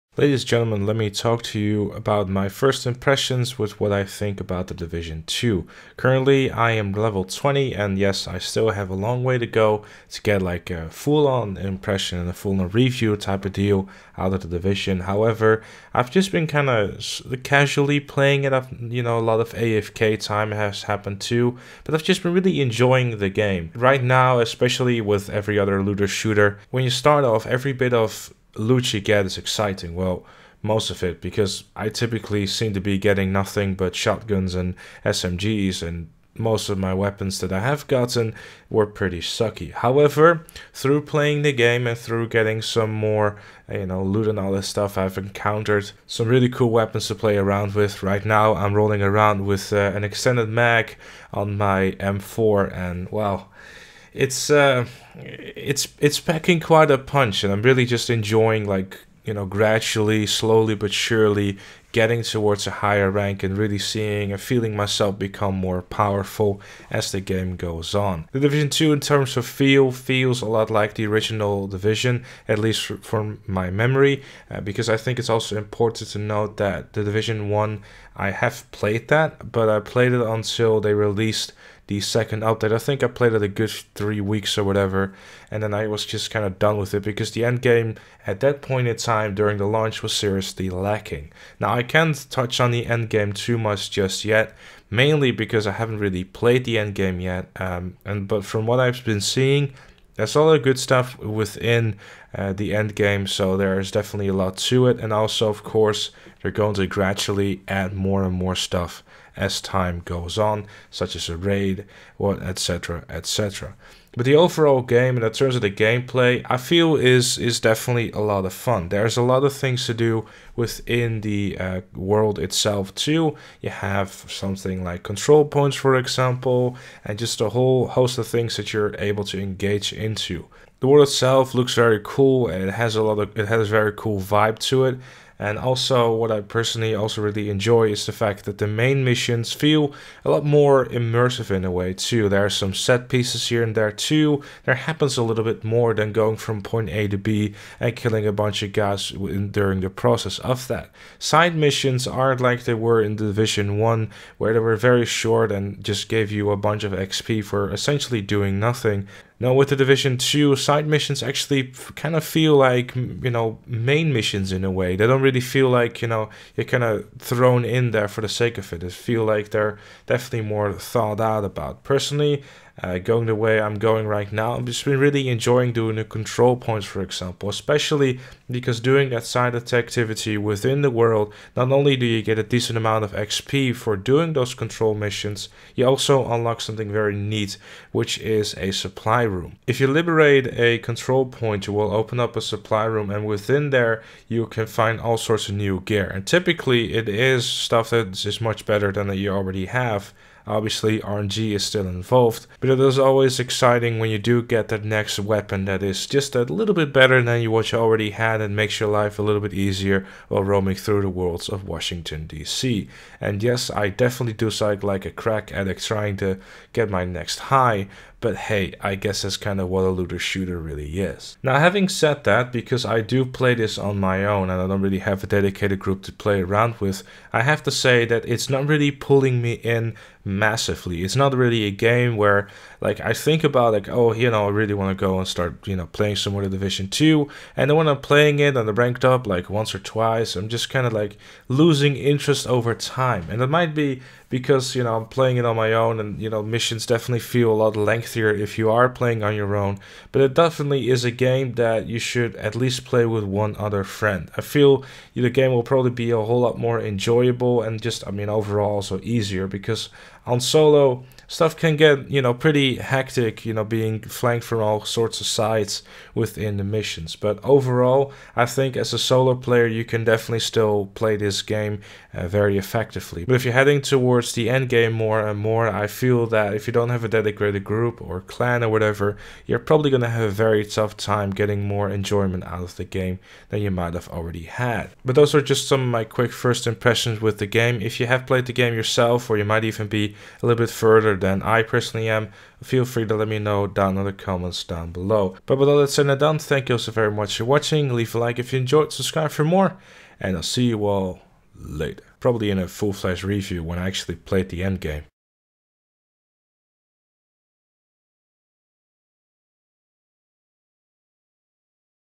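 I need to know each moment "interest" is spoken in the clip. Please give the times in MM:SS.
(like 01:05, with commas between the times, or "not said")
04:01.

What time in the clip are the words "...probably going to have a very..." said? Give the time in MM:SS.
04:39.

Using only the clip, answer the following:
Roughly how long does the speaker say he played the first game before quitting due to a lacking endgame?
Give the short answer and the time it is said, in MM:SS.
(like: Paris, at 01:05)
3 weeks, at 01:23.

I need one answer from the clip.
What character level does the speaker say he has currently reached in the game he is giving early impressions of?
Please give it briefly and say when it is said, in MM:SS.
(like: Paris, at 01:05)
20, at 00:06.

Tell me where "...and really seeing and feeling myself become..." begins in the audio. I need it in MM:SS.
01:03.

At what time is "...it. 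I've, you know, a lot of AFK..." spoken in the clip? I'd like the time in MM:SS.
00:18.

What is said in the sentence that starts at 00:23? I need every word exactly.
Right now, especially with every other looter shooter, when you start off, every bit of Lucci get is exciting?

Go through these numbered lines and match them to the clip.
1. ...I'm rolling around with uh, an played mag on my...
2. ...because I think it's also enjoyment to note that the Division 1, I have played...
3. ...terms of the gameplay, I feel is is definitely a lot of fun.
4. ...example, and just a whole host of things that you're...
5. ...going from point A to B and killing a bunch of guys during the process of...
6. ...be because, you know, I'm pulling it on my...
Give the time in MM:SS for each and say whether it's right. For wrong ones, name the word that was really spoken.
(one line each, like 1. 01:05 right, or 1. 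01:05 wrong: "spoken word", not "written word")
1. 00:48 wrong: "extended", not "played"
2. 01:14 wrong: "important", not "enjoyment"
3. 01:55 right
4. 02:05 right
5. 02:26 right
6. 04:03 wrong: "playing", not "pulling".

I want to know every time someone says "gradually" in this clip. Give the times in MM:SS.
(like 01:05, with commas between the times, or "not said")
00:59, 01:46.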